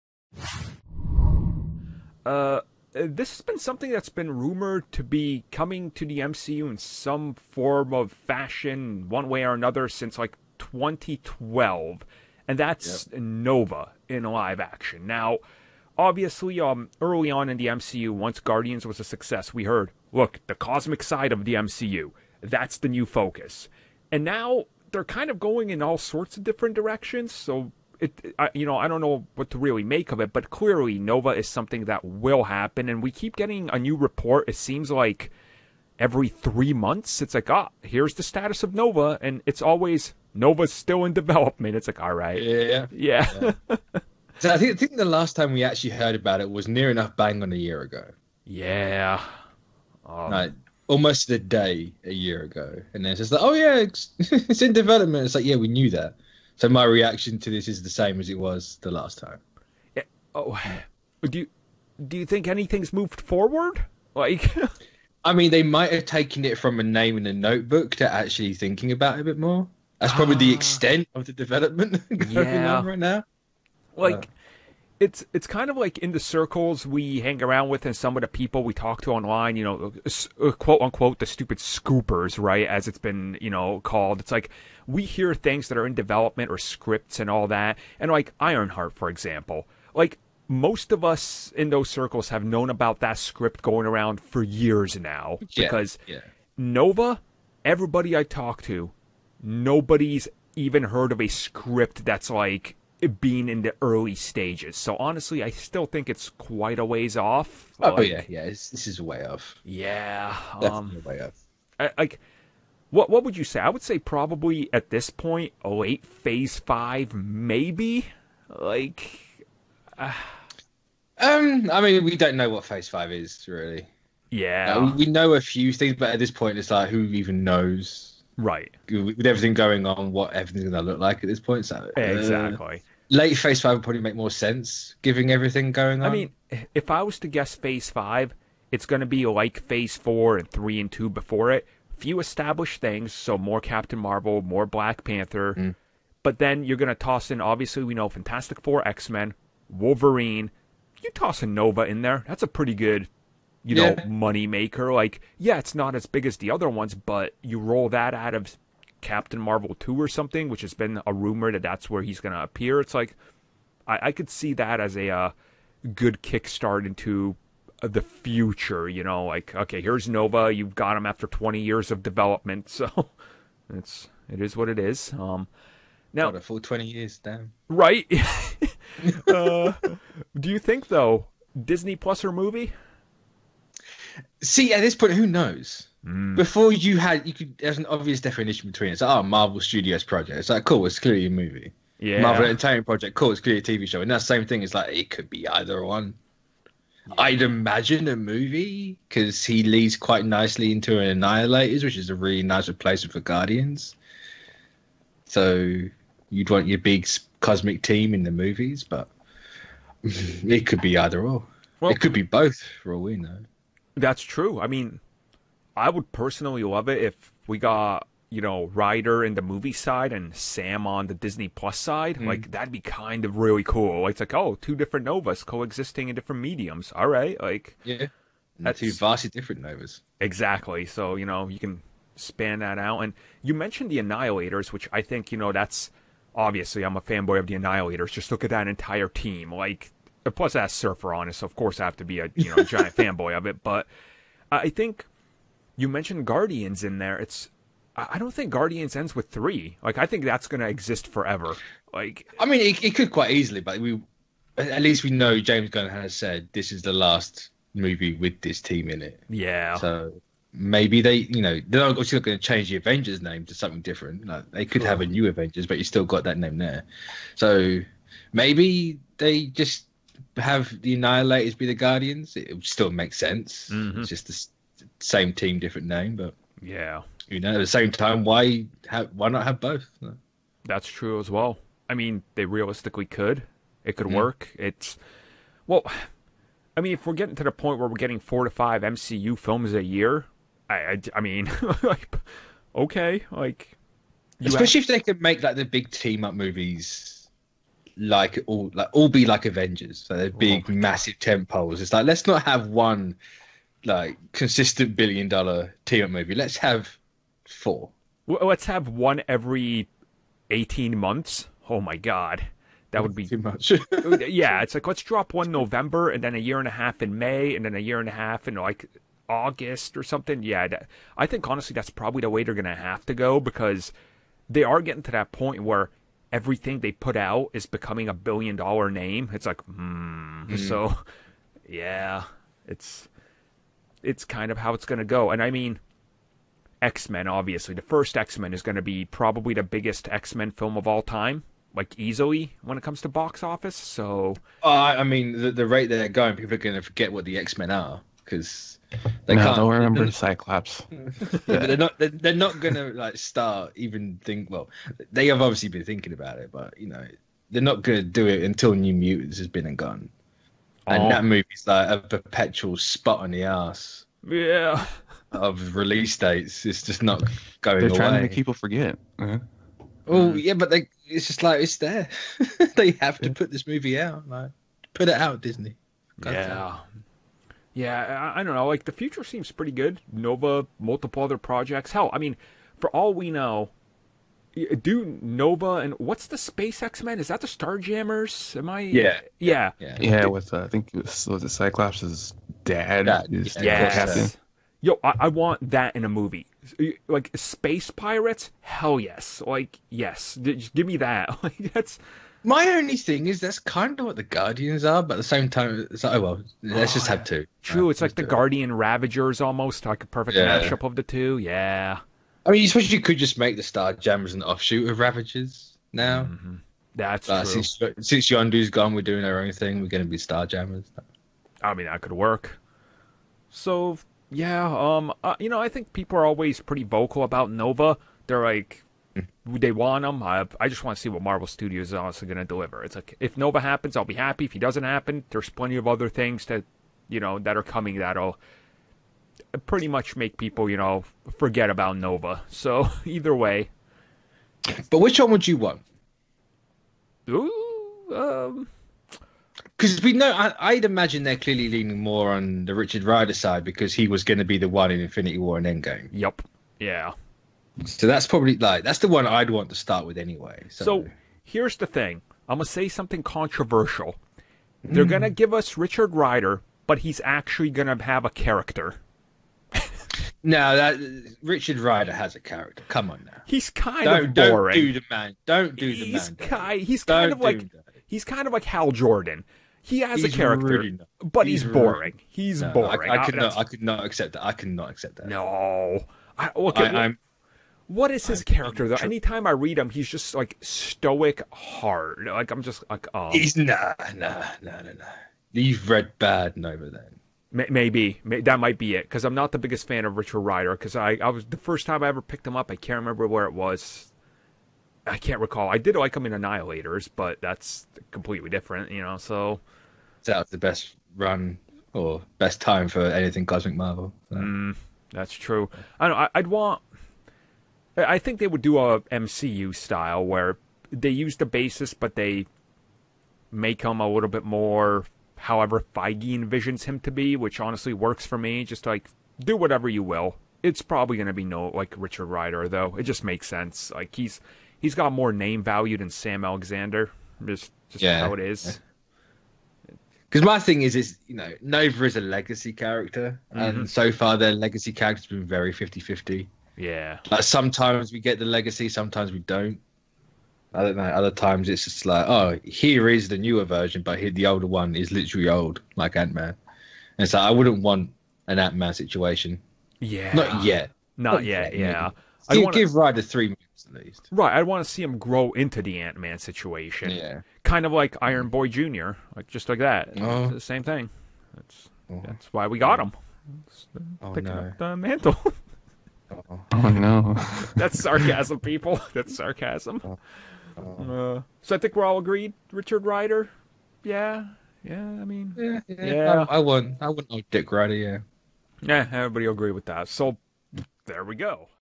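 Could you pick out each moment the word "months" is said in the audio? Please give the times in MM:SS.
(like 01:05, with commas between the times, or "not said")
00:36, 05:10.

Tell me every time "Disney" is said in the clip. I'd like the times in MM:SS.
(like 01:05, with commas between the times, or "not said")
03:01, 03:41, 06:15.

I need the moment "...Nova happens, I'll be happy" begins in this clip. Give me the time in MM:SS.
07:13.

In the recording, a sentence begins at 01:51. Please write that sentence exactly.
I, like, what what would you say?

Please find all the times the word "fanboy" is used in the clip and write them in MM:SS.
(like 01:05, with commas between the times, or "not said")
03:57, 04:02.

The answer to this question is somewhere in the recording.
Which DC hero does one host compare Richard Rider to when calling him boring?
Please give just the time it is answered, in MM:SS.
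07:58.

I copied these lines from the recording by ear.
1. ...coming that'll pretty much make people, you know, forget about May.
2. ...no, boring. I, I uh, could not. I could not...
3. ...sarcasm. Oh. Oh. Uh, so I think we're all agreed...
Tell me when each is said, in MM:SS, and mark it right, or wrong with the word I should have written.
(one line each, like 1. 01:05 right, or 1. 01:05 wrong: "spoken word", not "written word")
1. 07:17 wrong: "Nova", not "May"
2. 08:02 right
3. 09:39 right.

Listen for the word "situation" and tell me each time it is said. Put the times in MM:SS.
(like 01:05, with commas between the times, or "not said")
09:18, 09:26.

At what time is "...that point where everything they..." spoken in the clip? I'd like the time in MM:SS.
05:25.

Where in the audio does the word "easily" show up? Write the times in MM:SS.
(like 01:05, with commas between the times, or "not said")
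04:13, 05:41.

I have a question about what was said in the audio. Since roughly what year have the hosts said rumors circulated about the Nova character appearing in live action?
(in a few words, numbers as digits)
2012.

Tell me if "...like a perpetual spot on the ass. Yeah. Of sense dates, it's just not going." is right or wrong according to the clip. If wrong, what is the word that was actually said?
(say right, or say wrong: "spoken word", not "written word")
wrong: "release", not "sense".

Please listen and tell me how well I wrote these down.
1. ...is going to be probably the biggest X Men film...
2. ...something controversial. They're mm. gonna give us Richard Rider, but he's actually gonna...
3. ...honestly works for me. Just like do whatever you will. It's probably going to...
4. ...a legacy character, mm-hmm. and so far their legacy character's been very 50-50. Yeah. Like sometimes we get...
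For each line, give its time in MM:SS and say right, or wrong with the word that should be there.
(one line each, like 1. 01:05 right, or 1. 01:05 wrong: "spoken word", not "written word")
1. 05:38 right
2. 07:42 right
3. 08:47 right
4. 09:02 right.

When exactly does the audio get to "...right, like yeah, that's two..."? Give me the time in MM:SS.
03:47.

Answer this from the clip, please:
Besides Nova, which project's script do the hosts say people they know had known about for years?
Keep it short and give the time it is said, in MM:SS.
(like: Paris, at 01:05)
Ironheart, at 01:28.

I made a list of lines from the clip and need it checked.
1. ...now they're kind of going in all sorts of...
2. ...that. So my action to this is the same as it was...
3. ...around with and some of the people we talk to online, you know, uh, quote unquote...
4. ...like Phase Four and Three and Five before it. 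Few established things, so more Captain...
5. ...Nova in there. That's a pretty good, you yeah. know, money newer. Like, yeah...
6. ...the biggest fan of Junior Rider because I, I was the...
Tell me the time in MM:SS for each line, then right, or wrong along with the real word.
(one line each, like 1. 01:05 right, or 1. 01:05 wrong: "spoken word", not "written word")
1. 00:24 right
2. 00:55 wrong: "reaction", not "action"
3. 01:17 right
4. 02:19 wrong: "Two", not "Five"
5. 02:31 wrong: "maker", not "newer"
6. 08:19 wrong: "Richard", not "Junior".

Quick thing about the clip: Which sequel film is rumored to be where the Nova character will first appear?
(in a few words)
Captain Marvel 2.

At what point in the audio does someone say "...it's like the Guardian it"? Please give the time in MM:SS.
06:47.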